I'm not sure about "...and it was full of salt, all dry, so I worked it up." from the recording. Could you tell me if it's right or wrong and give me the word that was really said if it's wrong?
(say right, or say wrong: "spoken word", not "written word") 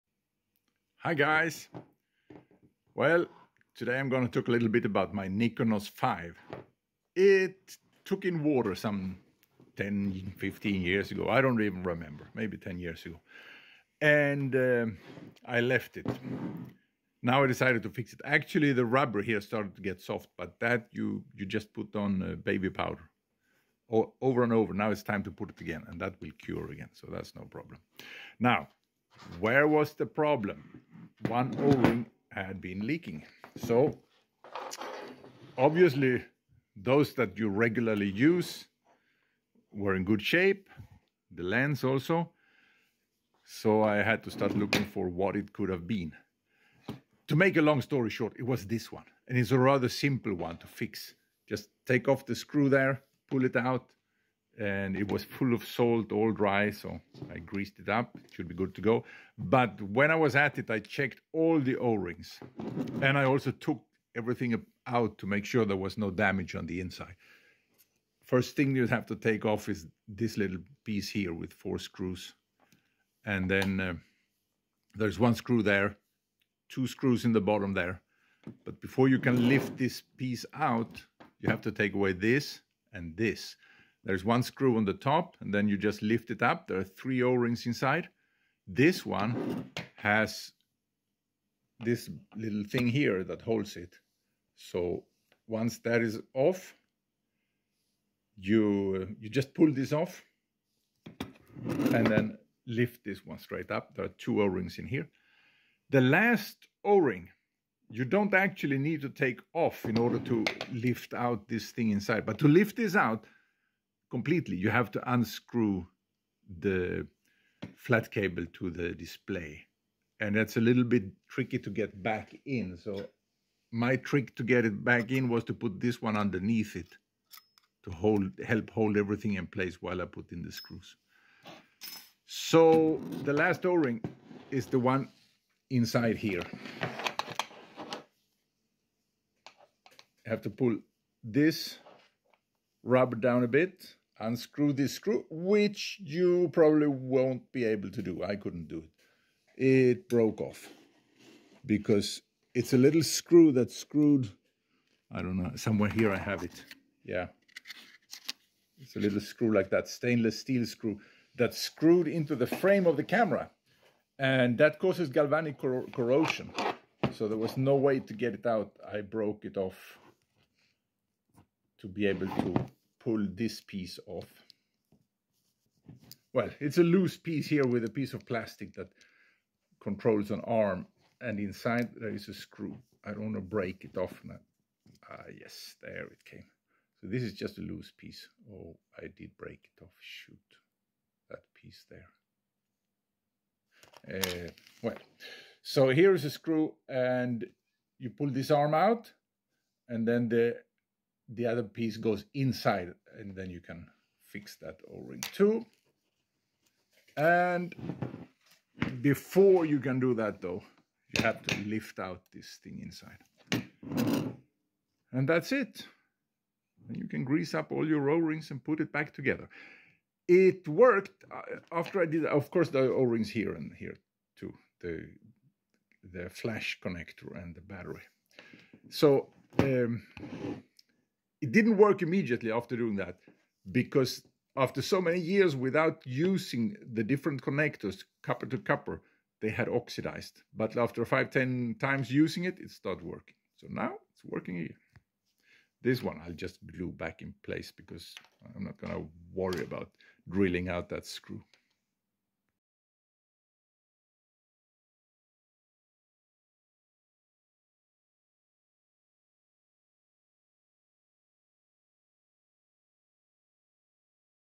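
wrong: "greased", not "worked".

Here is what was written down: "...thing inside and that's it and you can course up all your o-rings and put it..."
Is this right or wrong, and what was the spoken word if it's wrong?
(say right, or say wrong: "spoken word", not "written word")
wrong: "grease", not "course".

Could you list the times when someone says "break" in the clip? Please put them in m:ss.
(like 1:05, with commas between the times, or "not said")
3:03, 3:09.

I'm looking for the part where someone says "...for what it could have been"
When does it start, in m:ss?
0:44.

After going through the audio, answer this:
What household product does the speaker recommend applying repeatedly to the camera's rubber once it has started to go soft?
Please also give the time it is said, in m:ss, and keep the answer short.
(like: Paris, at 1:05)
Baby powder, at 0:22.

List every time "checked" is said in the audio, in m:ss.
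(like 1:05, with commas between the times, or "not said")
1:00.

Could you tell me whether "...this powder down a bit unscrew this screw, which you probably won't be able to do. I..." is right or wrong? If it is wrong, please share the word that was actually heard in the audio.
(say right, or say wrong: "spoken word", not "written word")
wrong: "rubber", not "powder".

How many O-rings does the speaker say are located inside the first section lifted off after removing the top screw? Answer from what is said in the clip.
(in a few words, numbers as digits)
3.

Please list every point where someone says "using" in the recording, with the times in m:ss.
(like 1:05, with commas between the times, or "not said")
3:56, 4:02.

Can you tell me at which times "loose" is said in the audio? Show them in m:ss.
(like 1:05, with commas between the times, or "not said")
2:56, 3:07.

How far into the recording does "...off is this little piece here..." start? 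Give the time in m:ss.
1:09.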